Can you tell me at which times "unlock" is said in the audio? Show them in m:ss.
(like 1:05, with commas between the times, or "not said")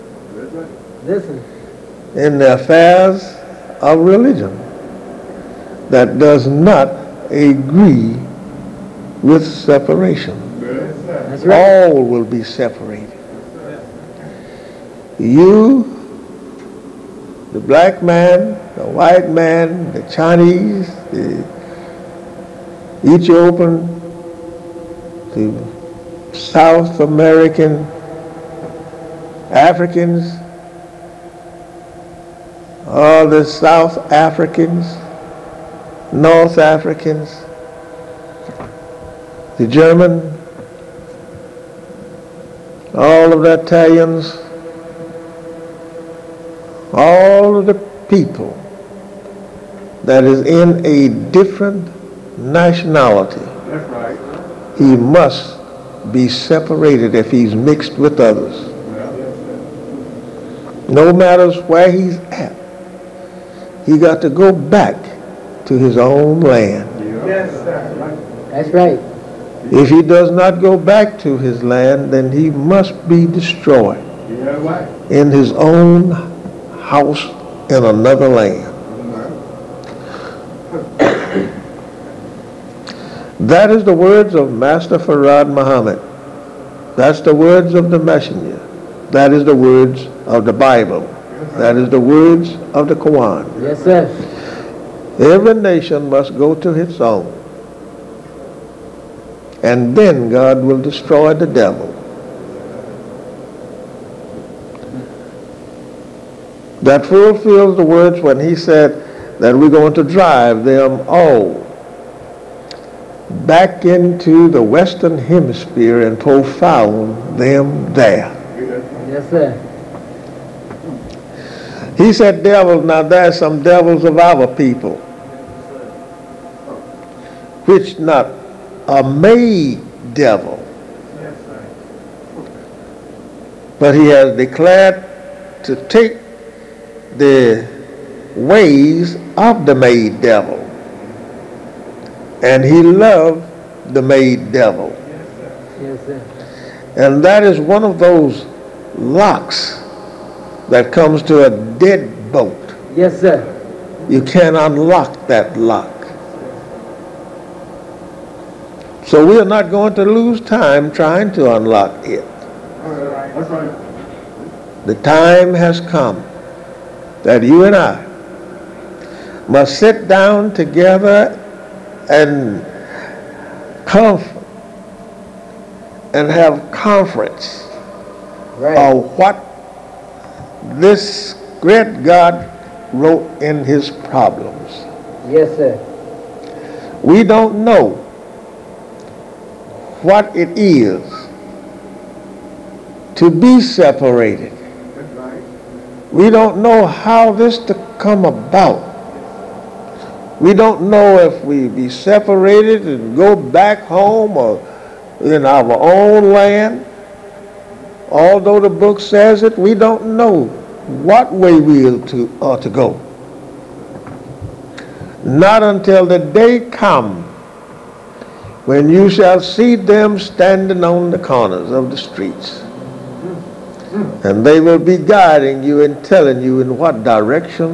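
2:34, 2:41.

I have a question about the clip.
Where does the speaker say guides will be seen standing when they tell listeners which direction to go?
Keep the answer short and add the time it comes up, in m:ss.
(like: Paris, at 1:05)
corners of the streets, at 3:41.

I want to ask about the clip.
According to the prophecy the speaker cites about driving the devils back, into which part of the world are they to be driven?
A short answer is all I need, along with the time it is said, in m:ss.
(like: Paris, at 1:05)
the Western Hemisphere, at 1:54.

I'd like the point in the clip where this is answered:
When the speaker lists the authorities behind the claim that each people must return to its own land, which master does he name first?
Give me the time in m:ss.
1:24.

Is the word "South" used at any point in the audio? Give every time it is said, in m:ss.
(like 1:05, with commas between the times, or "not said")
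0:26, 0:33.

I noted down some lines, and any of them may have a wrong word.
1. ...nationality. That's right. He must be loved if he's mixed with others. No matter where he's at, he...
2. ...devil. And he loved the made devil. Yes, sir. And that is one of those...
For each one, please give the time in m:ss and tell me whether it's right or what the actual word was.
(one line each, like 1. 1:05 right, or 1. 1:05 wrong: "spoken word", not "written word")
1. 0:52 wrong: "separated", not "loved"
2. 2:20 right.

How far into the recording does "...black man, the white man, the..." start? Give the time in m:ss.
0:17.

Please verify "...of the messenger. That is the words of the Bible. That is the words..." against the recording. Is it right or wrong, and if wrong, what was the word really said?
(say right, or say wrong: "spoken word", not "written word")
right.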